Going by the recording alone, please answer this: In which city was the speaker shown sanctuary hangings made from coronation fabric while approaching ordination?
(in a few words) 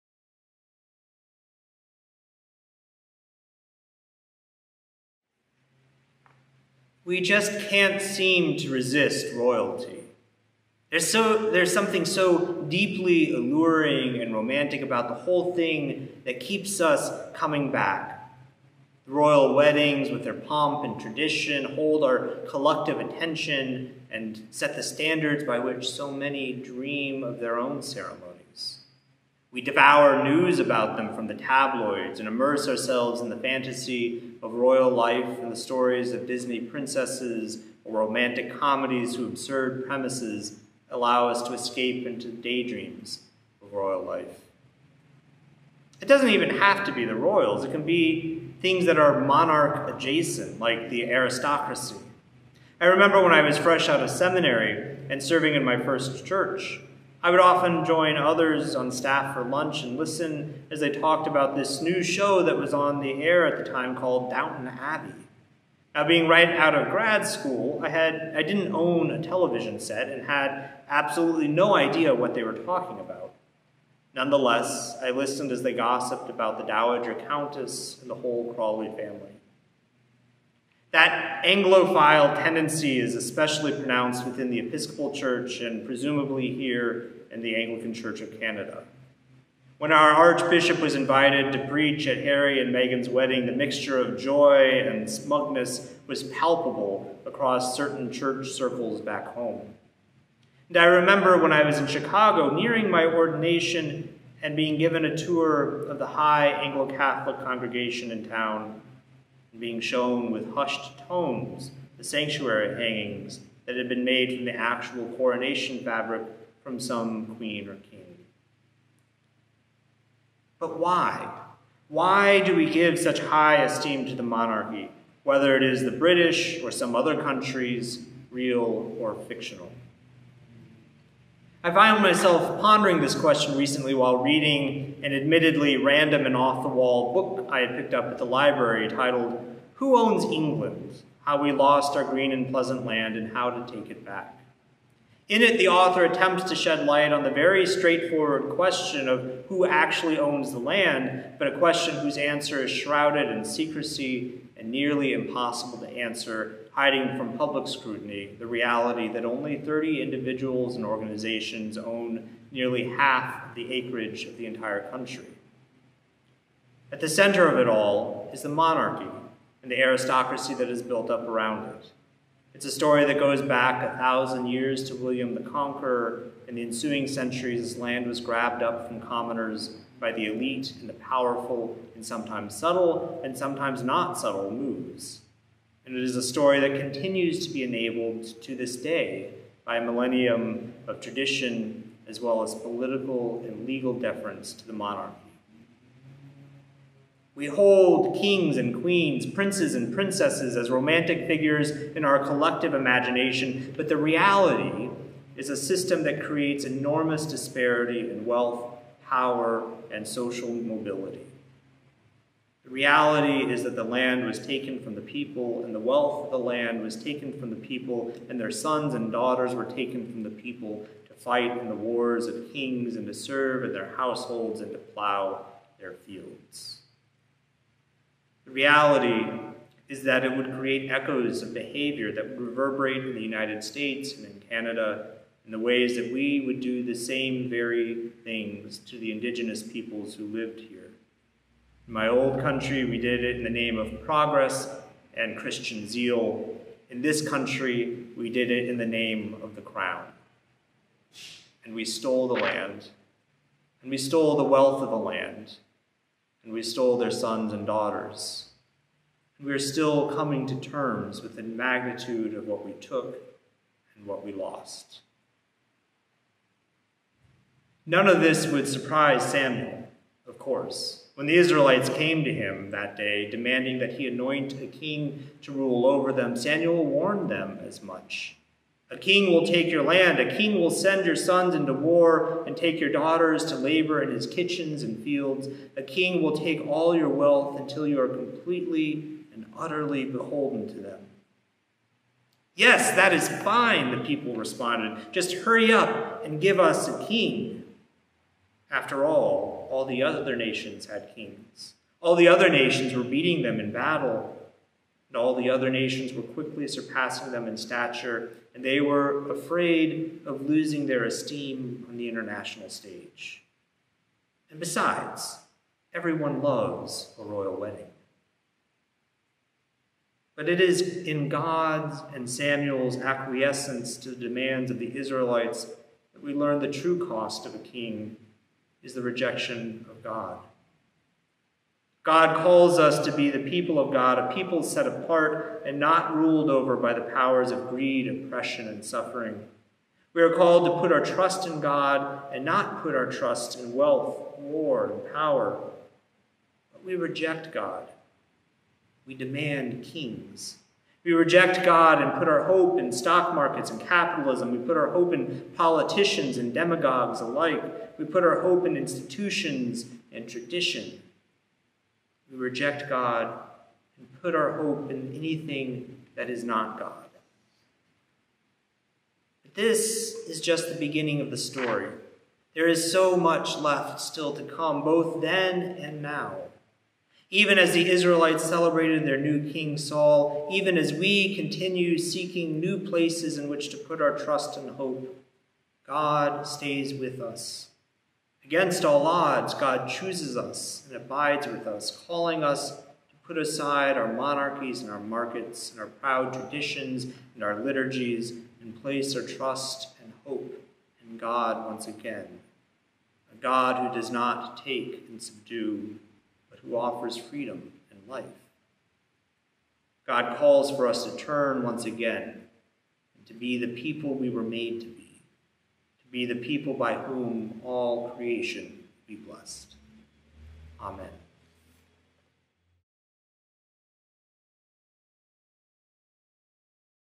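Chicago.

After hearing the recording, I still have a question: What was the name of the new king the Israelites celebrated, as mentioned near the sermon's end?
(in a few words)
Saul.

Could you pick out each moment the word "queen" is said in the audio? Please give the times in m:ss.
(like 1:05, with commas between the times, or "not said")
1:57, 3:18.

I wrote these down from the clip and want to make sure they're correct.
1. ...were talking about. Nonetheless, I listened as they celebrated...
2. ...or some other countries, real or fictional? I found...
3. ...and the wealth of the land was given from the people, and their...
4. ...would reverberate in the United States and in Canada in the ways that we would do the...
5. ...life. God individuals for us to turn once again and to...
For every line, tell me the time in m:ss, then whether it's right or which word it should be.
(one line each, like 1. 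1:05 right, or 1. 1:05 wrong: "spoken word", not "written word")
1. 1:12 wrong: "gossiped", not "celebrated"
2. 2:06 right
3. 3:35 wrong: "taken", not "given"
4. 3:52 right
5. 6:48 wrong: "calls", not "individuals".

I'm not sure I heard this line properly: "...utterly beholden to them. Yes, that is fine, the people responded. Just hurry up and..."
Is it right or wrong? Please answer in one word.
right.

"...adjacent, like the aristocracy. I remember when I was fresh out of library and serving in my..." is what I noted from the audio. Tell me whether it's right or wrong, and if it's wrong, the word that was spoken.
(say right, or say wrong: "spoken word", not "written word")
wrong: "seminary", not "library".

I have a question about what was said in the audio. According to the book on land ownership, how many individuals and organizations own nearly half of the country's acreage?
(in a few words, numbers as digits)
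30.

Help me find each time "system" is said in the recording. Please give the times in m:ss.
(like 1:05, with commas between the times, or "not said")
3:25.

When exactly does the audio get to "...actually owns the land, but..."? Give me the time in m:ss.
2:29.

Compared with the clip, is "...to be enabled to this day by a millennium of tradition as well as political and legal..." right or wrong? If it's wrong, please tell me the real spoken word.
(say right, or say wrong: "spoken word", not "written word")
right.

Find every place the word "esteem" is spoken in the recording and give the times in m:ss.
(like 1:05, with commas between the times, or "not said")
2:03, 5:11.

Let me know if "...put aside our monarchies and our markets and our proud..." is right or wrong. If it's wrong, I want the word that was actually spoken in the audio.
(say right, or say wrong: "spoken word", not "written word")
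right.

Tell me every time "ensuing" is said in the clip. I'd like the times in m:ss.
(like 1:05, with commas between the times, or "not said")
2:56.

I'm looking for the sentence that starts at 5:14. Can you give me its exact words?
And besides, everyone loves a royal wedding.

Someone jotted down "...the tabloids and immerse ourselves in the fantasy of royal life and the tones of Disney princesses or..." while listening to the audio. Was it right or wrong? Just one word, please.
wrong.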